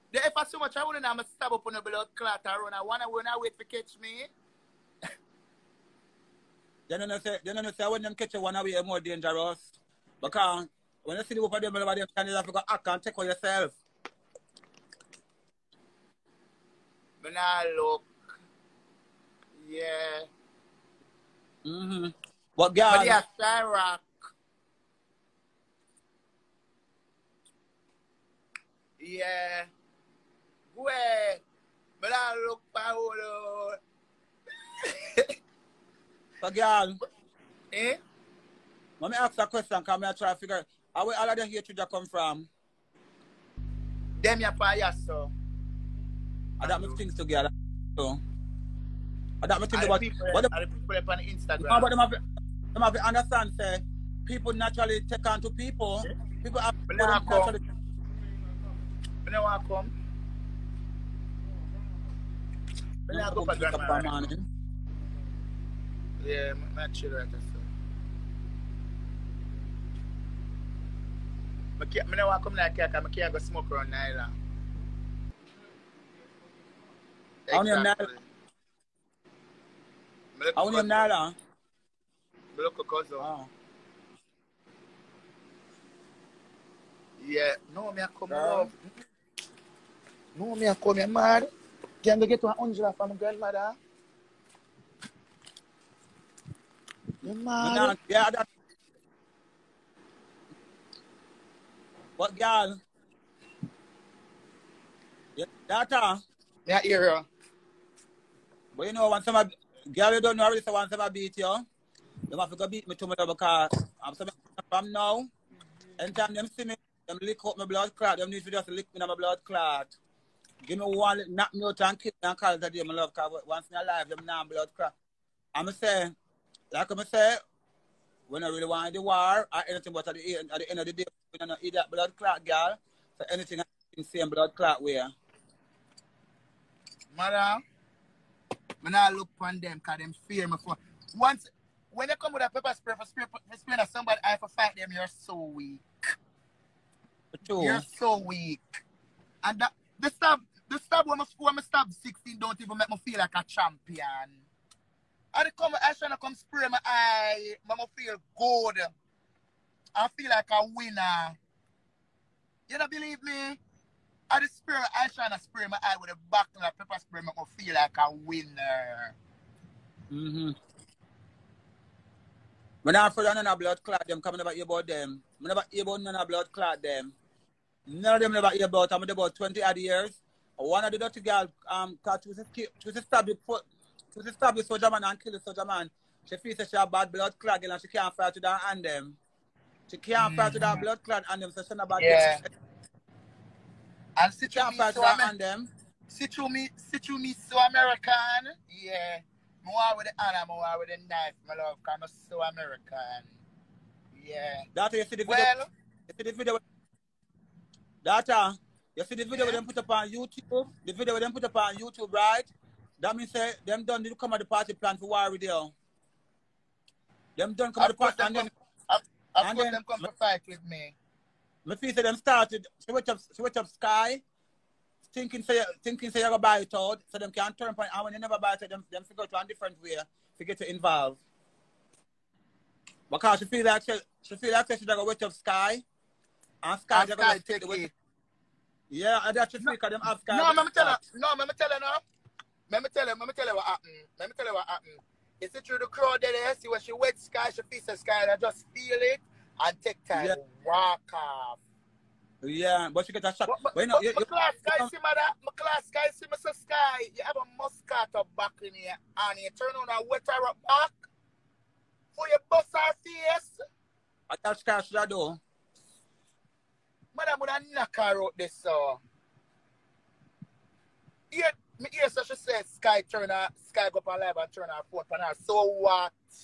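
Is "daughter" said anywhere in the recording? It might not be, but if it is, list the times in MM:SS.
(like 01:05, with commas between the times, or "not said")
01:45.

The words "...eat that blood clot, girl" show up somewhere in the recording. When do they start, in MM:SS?
02:11.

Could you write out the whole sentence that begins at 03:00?
One of the dirty girls, um, cause she was a stab the she stab the soldier man and kill the soldier man.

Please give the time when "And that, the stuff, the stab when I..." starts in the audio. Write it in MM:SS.
02:29.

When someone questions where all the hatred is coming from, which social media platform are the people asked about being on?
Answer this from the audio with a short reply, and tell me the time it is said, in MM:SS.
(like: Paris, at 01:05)
Instagram, at 00:51.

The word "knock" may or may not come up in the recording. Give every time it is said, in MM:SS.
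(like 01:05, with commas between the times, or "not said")
02:01, 04:27.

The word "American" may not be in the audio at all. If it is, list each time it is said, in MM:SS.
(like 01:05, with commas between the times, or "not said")
03:17, 03:22.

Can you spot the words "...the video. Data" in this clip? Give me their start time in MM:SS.
03:26.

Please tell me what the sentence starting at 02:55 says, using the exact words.
When about you about none of blood clot them.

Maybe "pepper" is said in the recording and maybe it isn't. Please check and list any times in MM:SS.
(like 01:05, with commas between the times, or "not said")
02:22, 02:46.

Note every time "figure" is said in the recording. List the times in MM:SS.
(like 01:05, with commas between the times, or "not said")
00:40, 03:49.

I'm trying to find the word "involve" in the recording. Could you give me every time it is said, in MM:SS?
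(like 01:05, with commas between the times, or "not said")
03:50.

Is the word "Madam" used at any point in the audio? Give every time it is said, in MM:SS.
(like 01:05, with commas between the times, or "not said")
02:17.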